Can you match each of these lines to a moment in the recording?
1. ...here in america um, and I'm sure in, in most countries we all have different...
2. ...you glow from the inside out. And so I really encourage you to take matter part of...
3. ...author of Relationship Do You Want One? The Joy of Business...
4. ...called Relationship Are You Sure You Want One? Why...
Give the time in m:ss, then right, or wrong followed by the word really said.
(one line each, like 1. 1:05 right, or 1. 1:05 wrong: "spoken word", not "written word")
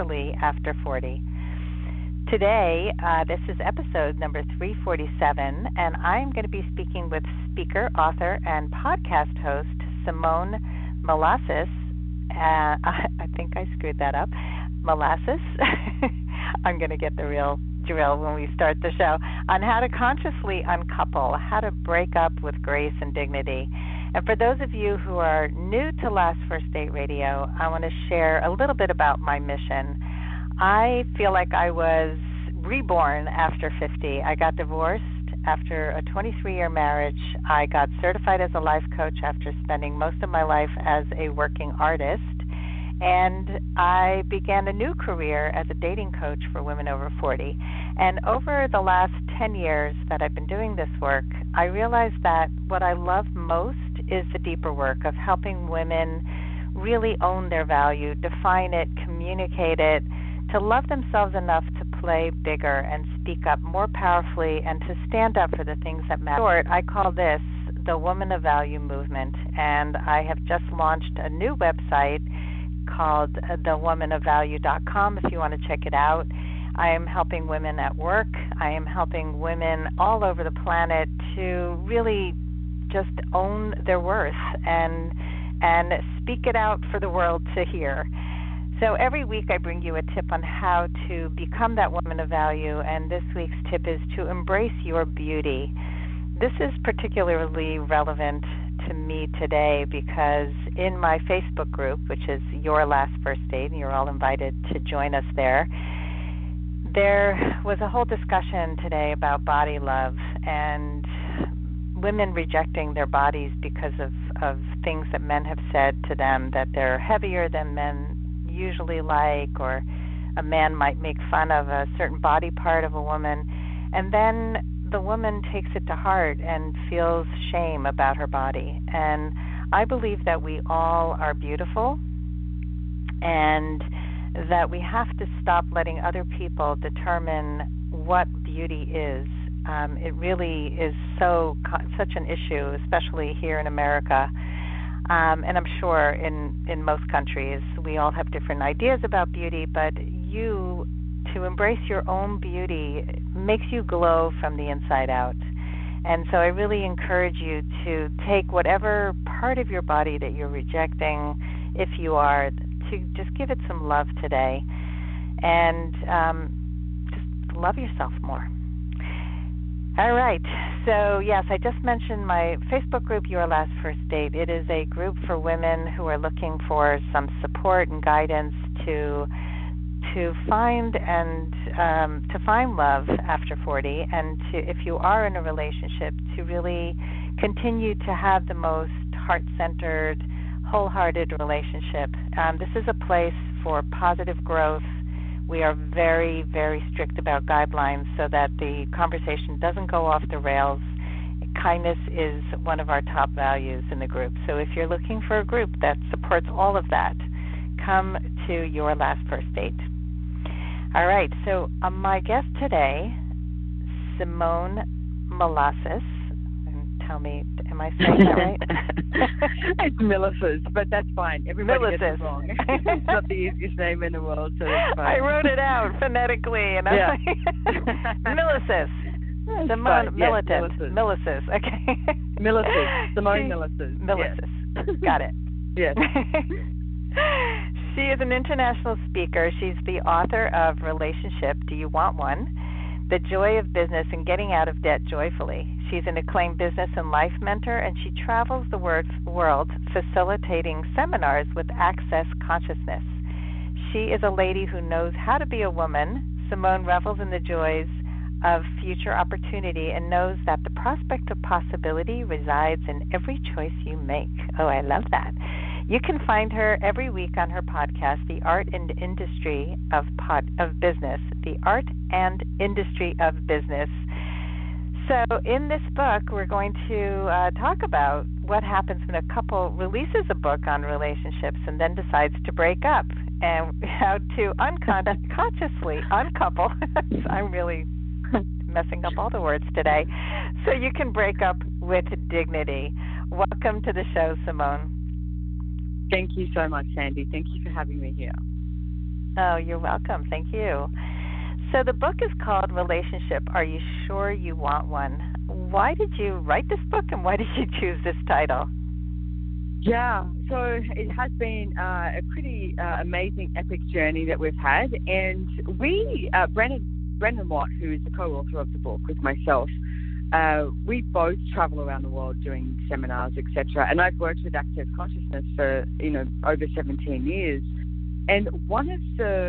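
1. 2:23 right
2. 2:33 wrong: "whatever", not "matter"
3. 4:00 right
4. 5:02 right.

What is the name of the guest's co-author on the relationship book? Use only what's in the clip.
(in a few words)
Brendan Watt.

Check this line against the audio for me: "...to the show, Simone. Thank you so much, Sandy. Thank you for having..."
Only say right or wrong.
right.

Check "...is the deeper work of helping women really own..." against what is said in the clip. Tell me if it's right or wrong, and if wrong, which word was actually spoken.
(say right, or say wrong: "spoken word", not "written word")
right.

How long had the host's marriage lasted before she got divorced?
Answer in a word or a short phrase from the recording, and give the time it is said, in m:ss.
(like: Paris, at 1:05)
23 years, at 0:36.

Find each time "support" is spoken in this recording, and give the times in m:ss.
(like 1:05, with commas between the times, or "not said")
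2:57, 3:26.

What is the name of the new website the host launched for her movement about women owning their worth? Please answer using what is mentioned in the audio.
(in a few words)
thewomanofvalue.com.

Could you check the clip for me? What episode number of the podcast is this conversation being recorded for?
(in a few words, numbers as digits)
347.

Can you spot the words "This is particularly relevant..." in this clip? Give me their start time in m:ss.
1:36.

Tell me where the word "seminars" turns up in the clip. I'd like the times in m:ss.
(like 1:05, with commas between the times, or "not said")
4:10, 5:22.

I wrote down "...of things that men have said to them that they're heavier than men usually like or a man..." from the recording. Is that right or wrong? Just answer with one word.
right.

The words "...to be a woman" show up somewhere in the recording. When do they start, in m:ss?
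4:15.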